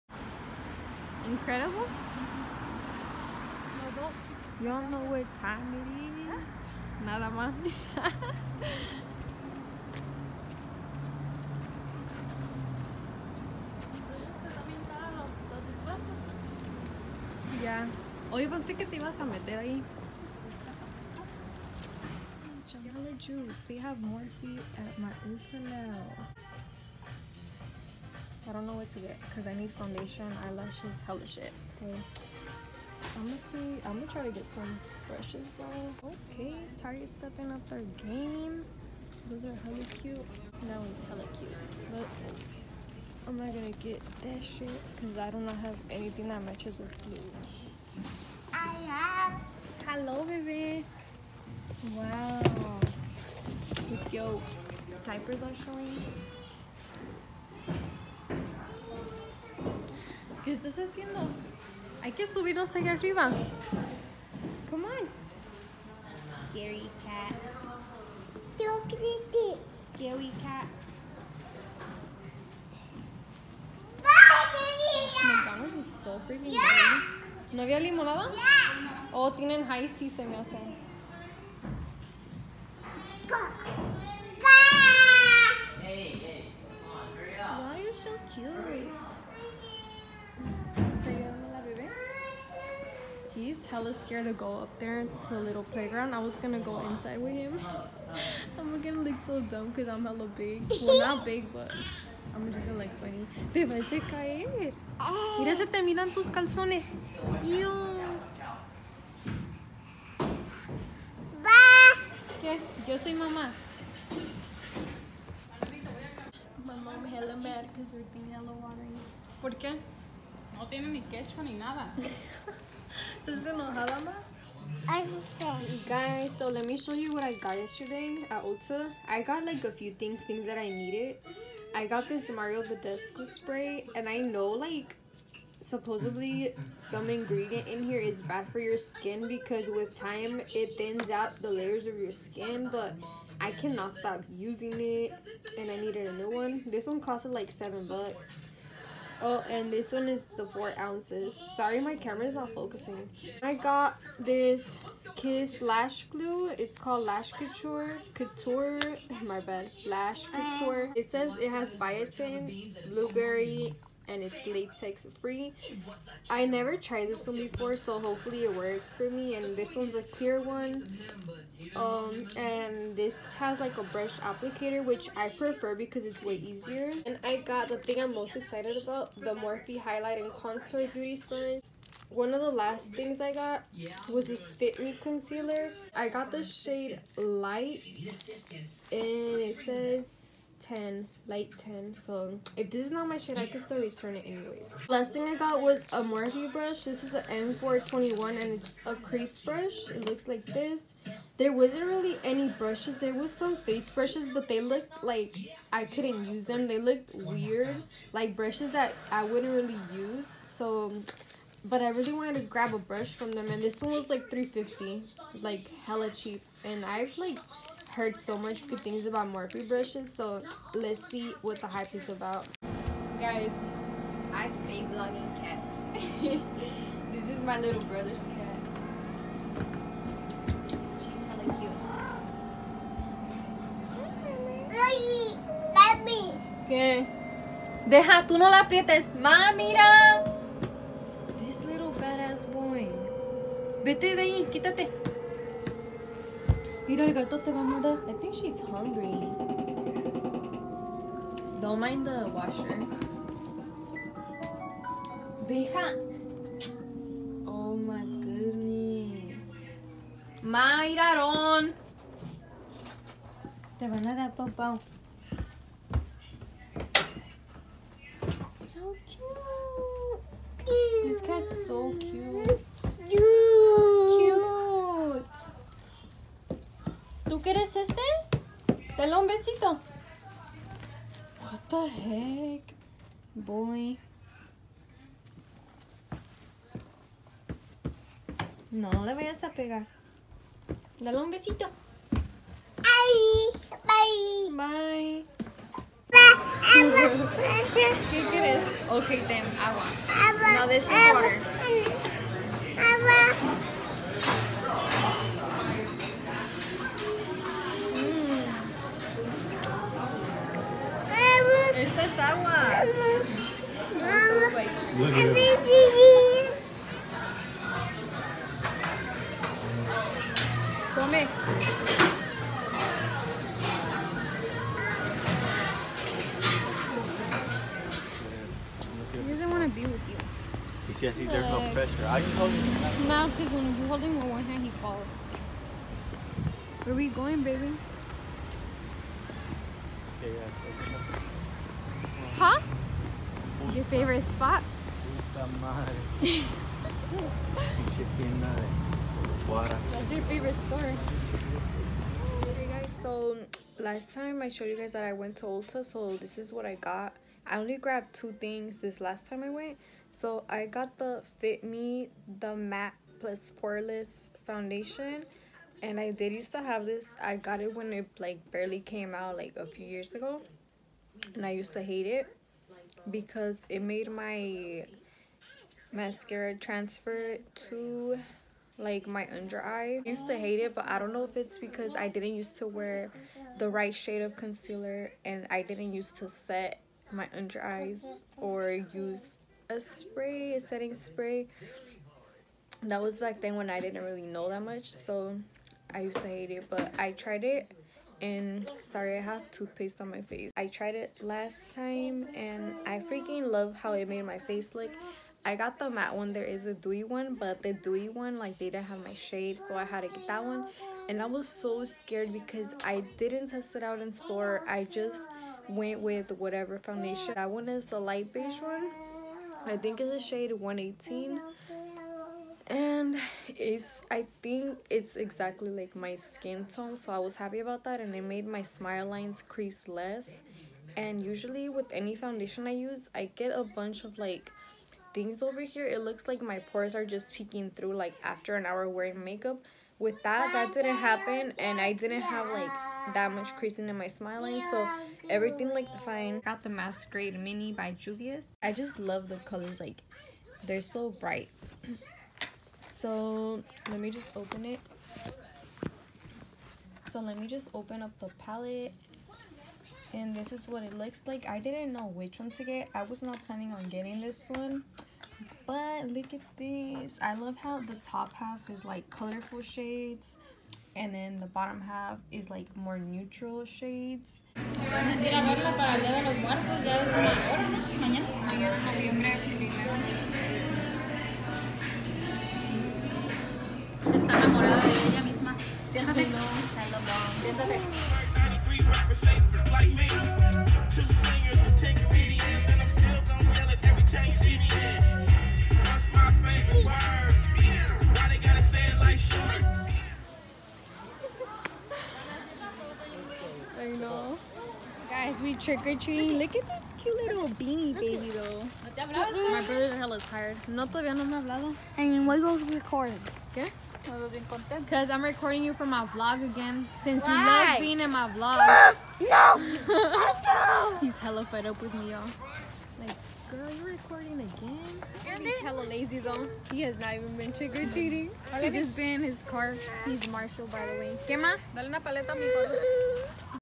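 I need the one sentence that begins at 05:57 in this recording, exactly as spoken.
I only grabbed two things this last time I went.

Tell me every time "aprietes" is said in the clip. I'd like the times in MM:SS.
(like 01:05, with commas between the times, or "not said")
03:58.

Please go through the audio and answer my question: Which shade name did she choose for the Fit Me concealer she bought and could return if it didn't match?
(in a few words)
Light 10.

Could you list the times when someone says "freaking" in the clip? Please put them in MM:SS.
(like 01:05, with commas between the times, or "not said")
01:16, 06:42.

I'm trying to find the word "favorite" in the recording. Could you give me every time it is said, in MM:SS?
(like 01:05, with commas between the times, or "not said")
05:43, 05:50.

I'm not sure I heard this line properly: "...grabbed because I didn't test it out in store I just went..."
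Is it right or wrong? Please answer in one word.
wrong.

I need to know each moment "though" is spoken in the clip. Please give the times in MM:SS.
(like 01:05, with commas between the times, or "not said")
00:35, 08:28, 08:46.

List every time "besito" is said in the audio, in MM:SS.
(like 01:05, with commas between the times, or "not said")
04:39, 04:51.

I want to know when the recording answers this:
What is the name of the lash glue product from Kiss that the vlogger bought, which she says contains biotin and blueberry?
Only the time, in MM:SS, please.
02:37.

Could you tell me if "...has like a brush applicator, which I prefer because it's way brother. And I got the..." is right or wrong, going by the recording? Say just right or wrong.
wrong.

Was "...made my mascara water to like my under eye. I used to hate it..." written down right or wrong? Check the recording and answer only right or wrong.
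wrong.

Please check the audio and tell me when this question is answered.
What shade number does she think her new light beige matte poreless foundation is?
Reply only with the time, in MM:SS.
07:00.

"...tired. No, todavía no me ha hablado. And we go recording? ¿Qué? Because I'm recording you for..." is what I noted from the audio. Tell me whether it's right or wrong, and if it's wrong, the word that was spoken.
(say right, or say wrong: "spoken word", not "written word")
right.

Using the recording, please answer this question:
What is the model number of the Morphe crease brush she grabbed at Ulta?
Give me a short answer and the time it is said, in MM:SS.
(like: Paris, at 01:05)
M421, at 03:17.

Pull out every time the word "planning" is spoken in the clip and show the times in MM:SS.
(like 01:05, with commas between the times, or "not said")
07:43.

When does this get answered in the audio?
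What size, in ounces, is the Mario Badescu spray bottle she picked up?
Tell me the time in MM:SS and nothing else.
02:30.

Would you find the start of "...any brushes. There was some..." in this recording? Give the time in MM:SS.
03:22.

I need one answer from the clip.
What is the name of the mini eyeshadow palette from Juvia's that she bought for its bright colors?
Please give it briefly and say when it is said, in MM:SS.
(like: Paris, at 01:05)
Masquerade mini, at 07:26.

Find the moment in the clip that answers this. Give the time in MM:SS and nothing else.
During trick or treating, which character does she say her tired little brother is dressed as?
08:50.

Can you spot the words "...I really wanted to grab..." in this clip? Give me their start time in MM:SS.
03:31.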